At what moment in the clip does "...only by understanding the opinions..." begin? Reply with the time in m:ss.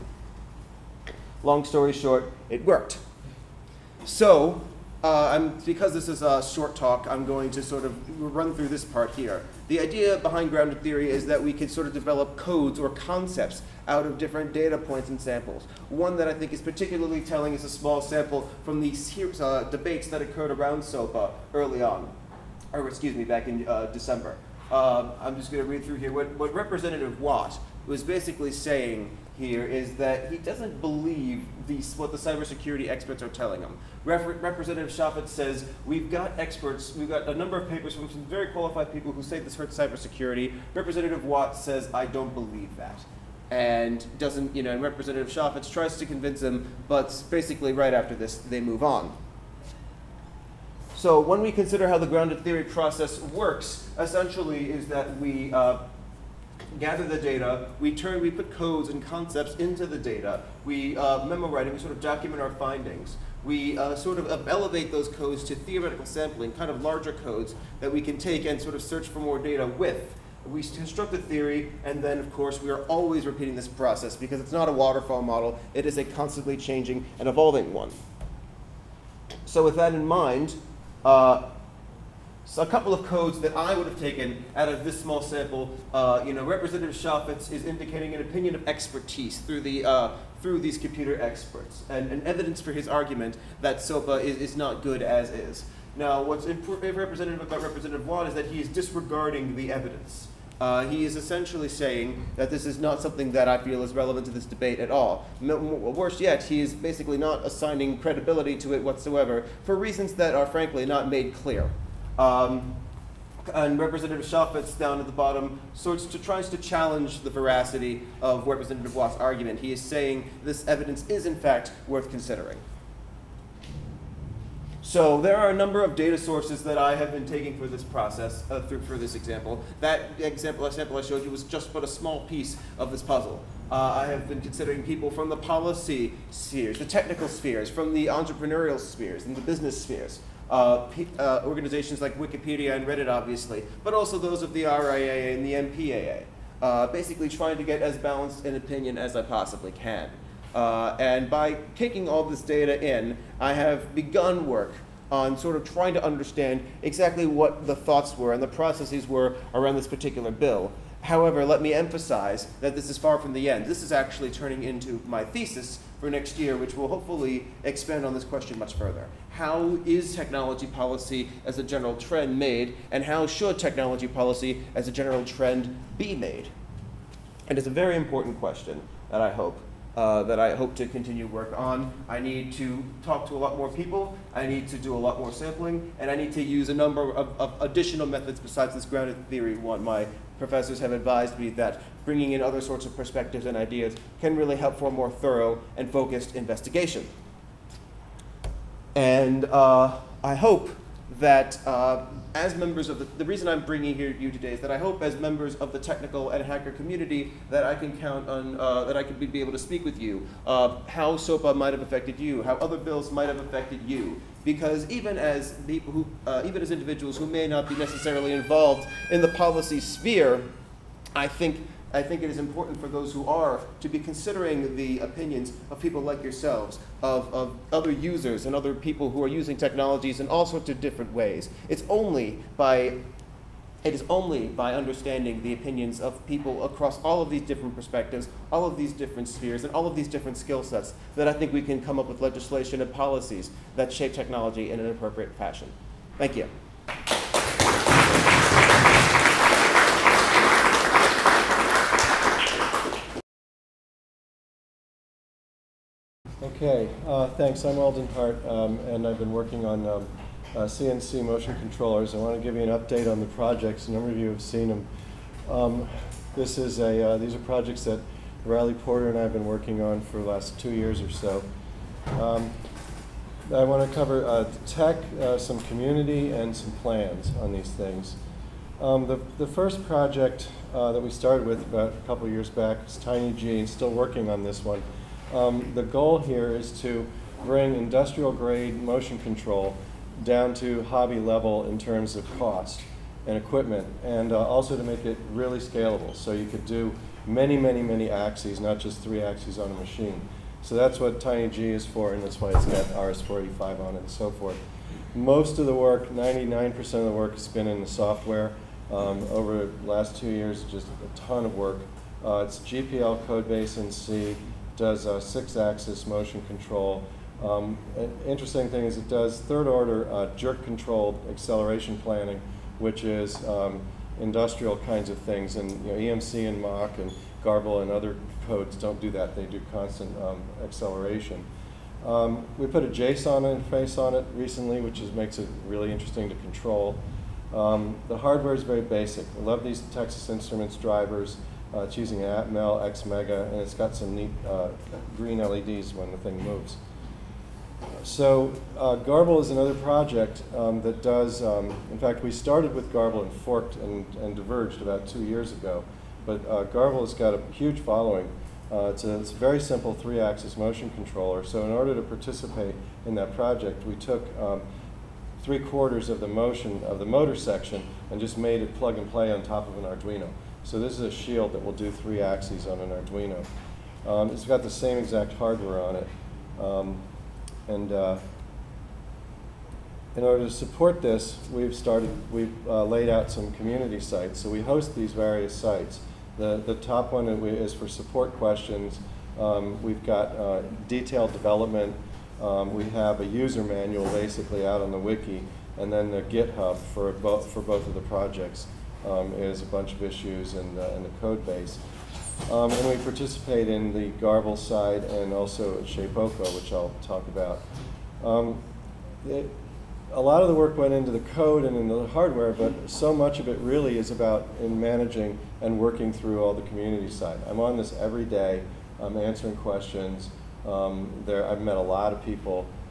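3:54.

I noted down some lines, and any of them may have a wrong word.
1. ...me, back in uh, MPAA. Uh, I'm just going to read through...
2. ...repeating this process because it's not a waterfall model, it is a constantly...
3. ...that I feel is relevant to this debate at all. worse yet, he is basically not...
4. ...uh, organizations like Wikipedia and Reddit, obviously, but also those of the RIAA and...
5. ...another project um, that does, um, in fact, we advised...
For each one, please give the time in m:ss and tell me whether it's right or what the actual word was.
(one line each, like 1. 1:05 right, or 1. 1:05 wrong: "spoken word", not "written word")
1. 0:23 wrong: "December", not "MPAA"
2. 1:13 right
3. 1:43 right
4. 2:21 right
5. 5:49 wrong: "started", not "advised".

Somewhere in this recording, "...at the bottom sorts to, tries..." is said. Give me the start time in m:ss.
1:54.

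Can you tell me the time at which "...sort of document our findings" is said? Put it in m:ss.
1:01.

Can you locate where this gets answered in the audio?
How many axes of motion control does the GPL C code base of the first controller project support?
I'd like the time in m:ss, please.
5:15.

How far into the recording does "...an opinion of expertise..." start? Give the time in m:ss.
1:28.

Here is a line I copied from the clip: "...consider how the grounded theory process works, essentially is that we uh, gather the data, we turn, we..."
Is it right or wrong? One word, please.
right.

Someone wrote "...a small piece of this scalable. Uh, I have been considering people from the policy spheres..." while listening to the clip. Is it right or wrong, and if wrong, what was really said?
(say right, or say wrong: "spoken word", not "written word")
wrong: "puzzle", not "scalable".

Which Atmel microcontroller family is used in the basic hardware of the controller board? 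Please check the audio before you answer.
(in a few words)
X Mega.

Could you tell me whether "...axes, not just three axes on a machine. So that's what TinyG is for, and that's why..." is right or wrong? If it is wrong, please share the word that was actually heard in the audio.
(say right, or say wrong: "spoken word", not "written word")
right.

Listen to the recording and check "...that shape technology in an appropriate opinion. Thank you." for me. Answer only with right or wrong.
wrong.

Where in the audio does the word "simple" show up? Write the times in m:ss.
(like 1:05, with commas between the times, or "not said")
5:59.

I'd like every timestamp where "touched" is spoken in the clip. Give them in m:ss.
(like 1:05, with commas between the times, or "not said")
not said.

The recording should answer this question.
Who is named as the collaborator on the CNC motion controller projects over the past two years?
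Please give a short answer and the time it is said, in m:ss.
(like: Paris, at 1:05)
Riley Porter, at 4:28.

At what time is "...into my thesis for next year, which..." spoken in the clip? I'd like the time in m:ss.
2:44.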